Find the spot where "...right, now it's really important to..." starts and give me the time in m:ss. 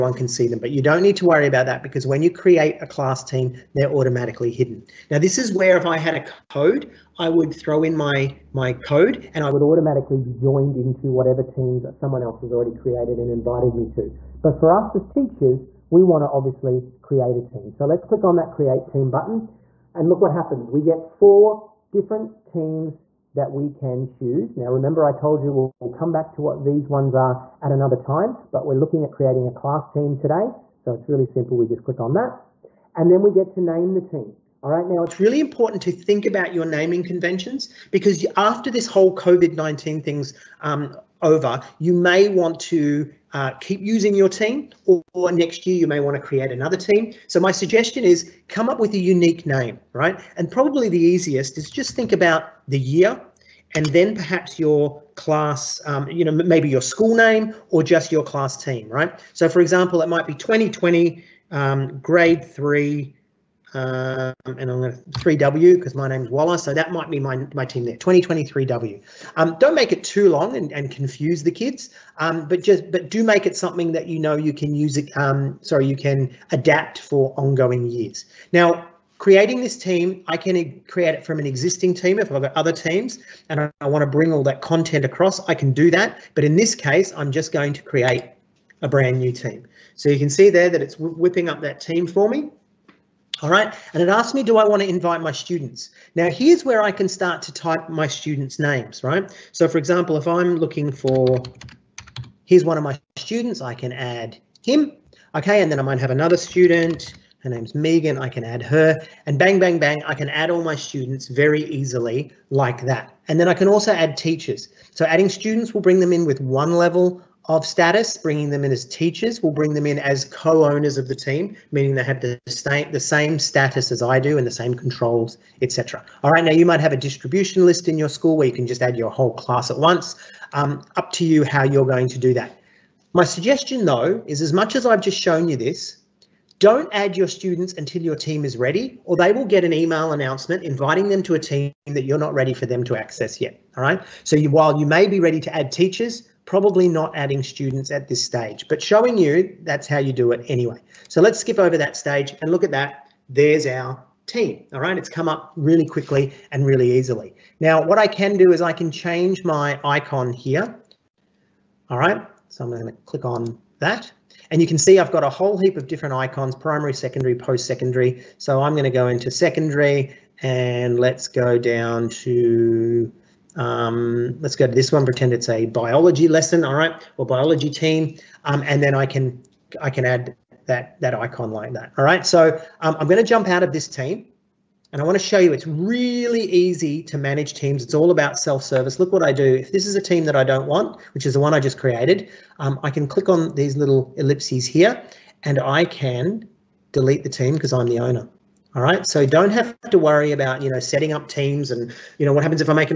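0:34.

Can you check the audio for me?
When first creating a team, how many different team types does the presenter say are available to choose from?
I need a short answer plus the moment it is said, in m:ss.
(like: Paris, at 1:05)
4, at 0:21.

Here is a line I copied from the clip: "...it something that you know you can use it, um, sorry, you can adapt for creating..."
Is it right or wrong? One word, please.
wrong.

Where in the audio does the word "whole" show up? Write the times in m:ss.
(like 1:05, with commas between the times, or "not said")
0:38, 2:09, 2:45.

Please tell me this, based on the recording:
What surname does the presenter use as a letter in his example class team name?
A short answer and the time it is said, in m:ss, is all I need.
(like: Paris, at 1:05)
Waller, at 1:06.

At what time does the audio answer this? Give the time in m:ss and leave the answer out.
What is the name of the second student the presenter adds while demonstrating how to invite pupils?
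1:47.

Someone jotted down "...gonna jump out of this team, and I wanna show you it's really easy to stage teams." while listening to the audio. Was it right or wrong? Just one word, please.
wrong.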